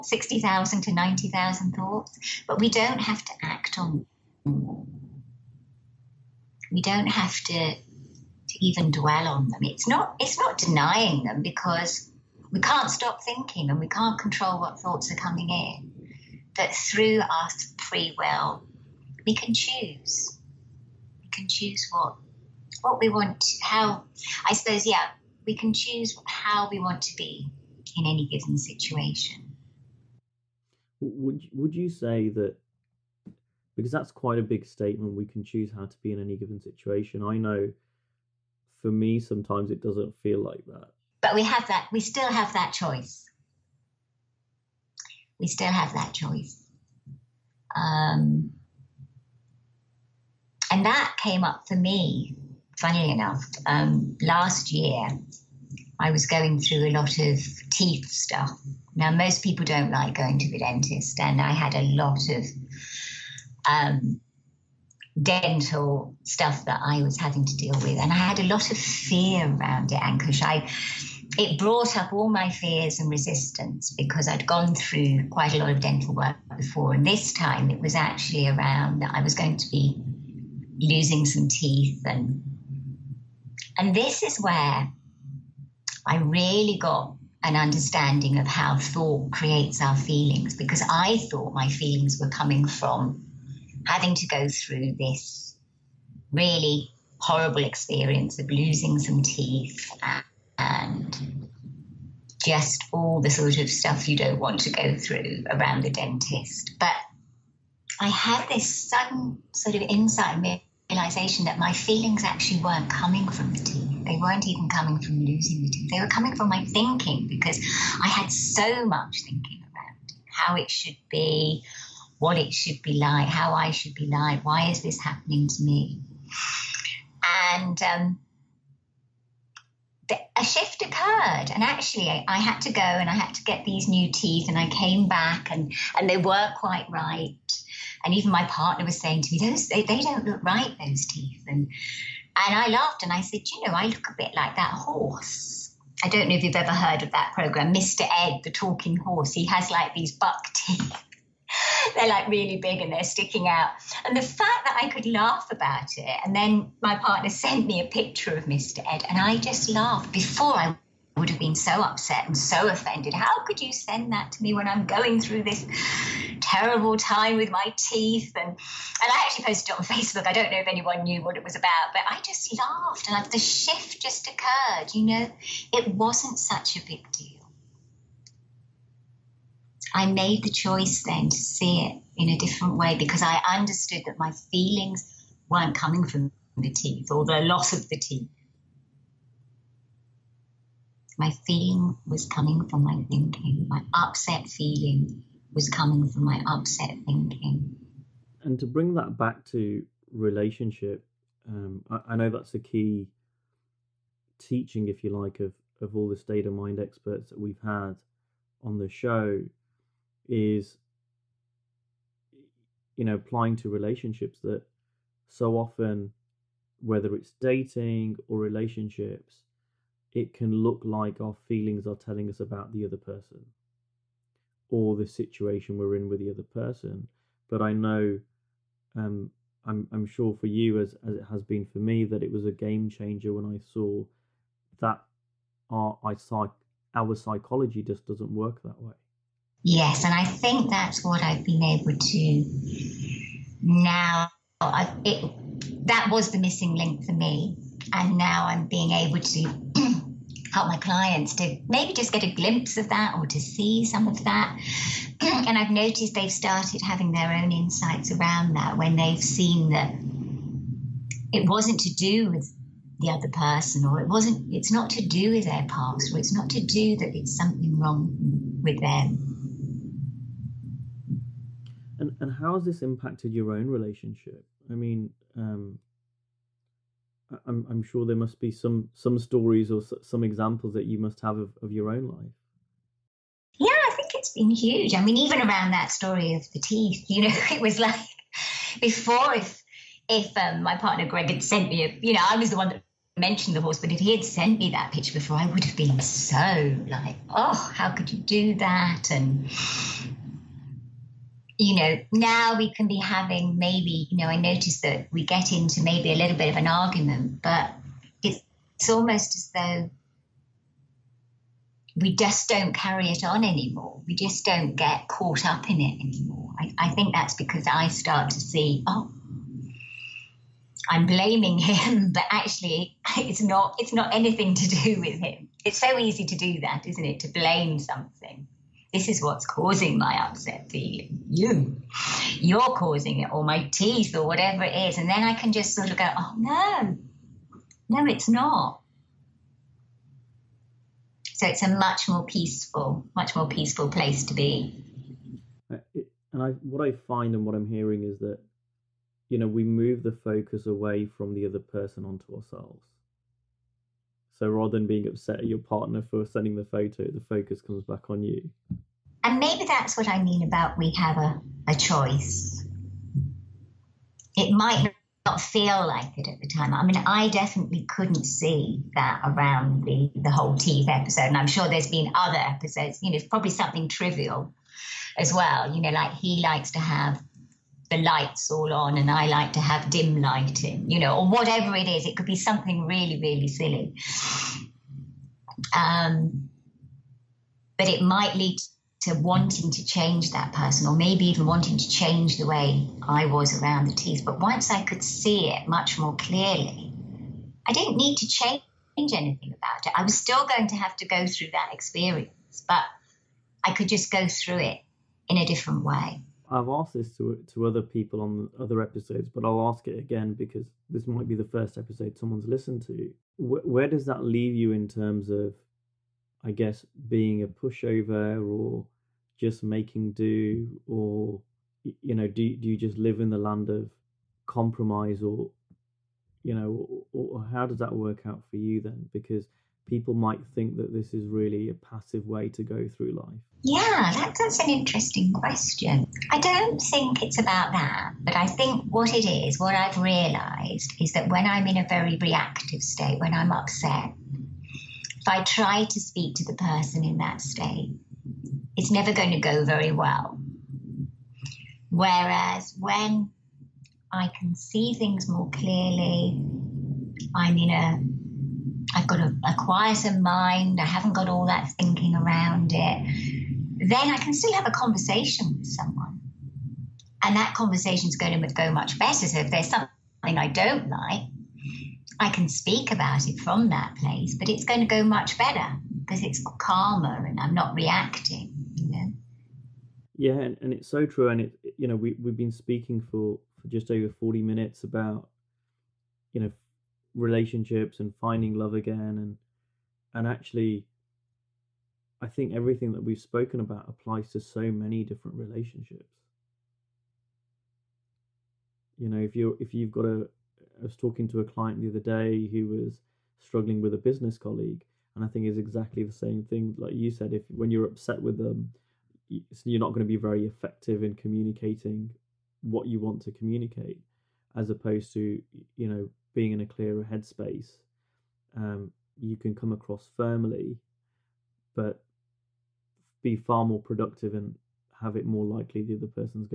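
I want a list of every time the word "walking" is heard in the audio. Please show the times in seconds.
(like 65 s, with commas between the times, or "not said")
not said.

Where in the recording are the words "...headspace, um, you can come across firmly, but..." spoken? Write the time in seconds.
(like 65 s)
517 s.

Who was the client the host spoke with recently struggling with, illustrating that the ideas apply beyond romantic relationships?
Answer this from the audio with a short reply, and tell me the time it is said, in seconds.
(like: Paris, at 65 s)
A business colleague, at 503 s.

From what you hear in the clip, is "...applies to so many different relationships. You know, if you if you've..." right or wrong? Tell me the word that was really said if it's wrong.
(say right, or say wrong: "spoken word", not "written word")
right.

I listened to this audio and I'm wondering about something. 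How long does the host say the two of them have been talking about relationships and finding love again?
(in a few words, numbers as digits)
Just over 40 minutes.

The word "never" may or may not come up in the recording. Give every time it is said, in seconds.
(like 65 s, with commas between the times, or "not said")
448 s.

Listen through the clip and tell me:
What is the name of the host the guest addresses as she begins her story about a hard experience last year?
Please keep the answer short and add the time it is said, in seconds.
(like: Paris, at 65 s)
Ankush, at 69 s.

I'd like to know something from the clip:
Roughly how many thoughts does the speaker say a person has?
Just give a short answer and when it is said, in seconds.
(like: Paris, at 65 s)
60,000 to 90,000, at 0 s.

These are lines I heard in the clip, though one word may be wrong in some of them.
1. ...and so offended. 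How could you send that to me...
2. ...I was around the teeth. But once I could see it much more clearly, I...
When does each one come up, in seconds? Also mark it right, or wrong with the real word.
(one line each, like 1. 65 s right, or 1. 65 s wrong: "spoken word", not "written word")
1. 162 s right
2. 393 s right.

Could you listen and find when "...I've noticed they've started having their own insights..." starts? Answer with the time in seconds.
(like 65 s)
255 s.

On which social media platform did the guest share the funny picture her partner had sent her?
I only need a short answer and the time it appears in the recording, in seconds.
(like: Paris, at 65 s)
Facebook, at 169 s.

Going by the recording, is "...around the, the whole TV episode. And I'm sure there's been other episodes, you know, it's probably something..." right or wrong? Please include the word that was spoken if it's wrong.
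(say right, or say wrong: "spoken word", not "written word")
right.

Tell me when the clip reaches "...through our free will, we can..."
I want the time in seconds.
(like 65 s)
16 s.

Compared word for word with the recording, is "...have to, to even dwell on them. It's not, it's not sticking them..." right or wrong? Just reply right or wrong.
wrong.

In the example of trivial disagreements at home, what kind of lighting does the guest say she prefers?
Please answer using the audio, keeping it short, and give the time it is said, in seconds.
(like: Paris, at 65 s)
Dim lighting, at 379 s.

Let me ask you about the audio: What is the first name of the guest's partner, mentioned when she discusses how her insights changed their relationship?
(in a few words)
Greg.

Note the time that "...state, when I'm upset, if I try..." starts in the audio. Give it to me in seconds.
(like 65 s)
442 s.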